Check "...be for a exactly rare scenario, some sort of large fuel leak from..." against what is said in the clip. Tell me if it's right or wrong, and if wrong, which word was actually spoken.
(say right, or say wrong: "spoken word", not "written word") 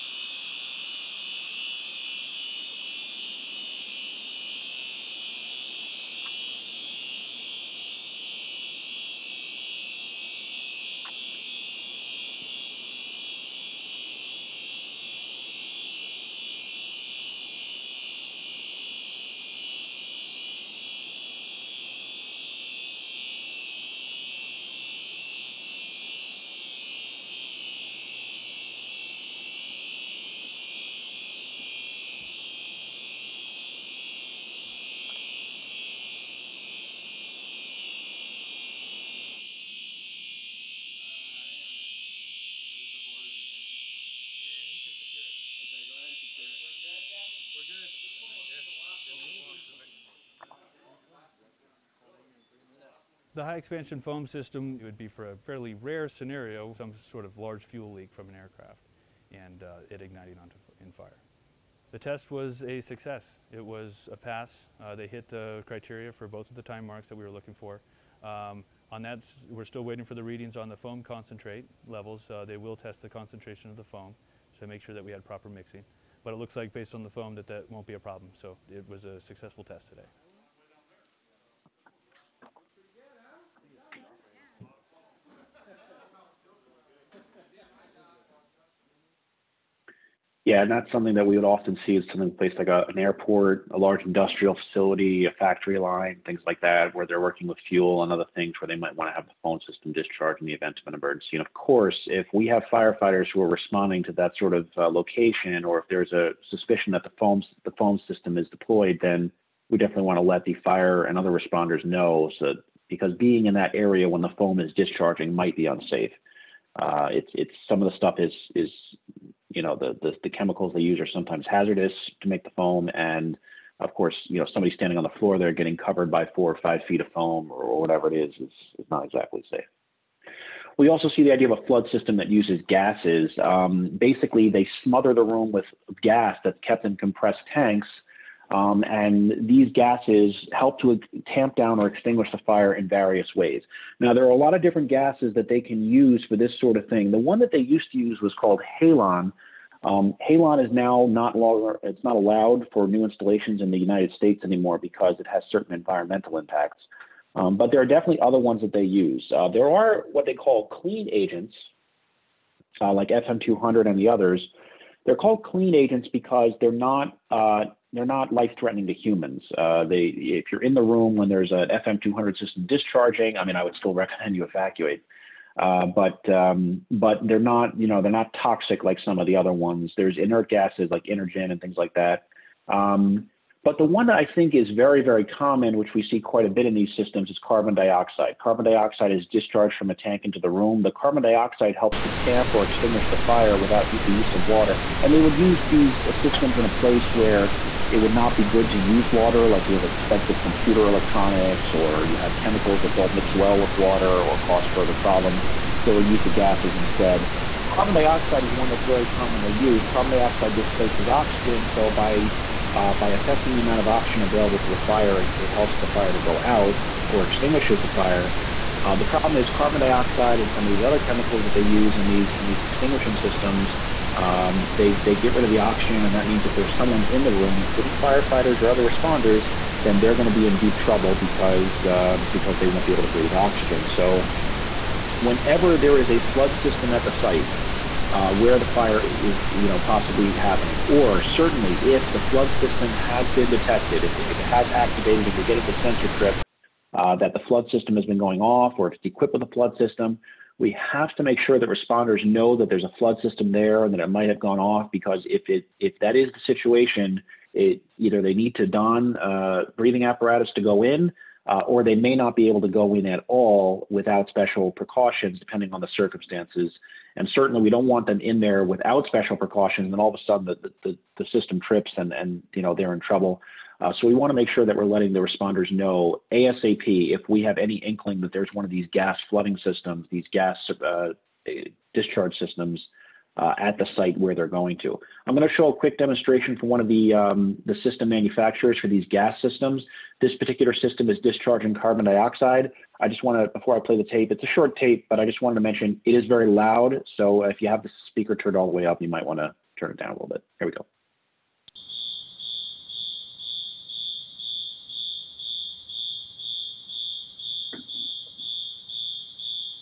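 wrong: "fairly", not "exactly".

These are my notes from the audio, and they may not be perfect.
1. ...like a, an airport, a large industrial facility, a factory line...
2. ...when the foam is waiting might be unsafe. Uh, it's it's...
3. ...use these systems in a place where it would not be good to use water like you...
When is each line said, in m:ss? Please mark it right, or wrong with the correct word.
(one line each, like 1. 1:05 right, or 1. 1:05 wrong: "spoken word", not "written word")
1. 1:32 right
2. 1:54 wrong: "discharging", not "waiting"
3. 3:15 right.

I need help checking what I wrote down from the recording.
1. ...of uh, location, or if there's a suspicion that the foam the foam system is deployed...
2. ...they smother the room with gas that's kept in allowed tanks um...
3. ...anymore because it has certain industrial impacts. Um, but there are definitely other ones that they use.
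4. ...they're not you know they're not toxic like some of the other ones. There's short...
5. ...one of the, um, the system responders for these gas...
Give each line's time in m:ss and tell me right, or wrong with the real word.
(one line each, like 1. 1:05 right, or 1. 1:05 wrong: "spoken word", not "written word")
1. 1:44 right
2. 2:14 wrong: "compressed", not "allowed"
3. 2:34 wrong: "environmental", not "industrial"
4. 2:57 wrong: "inert", not "short"
5. 4:46 wrong: "manufacturers", not "responders".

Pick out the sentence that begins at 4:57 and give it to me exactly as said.
So if you have the speaker turned all the way up, you might want to turn it down a little bit.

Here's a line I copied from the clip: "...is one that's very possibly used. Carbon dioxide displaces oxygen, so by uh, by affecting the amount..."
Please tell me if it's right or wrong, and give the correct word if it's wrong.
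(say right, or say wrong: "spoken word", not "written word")
wrong: "commonly", not "possibly".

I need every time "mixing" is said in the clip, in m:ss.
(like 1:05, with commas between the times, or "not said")
1:15.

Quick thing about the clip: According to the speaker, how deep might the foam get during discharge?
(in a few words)
4 or 5 feet.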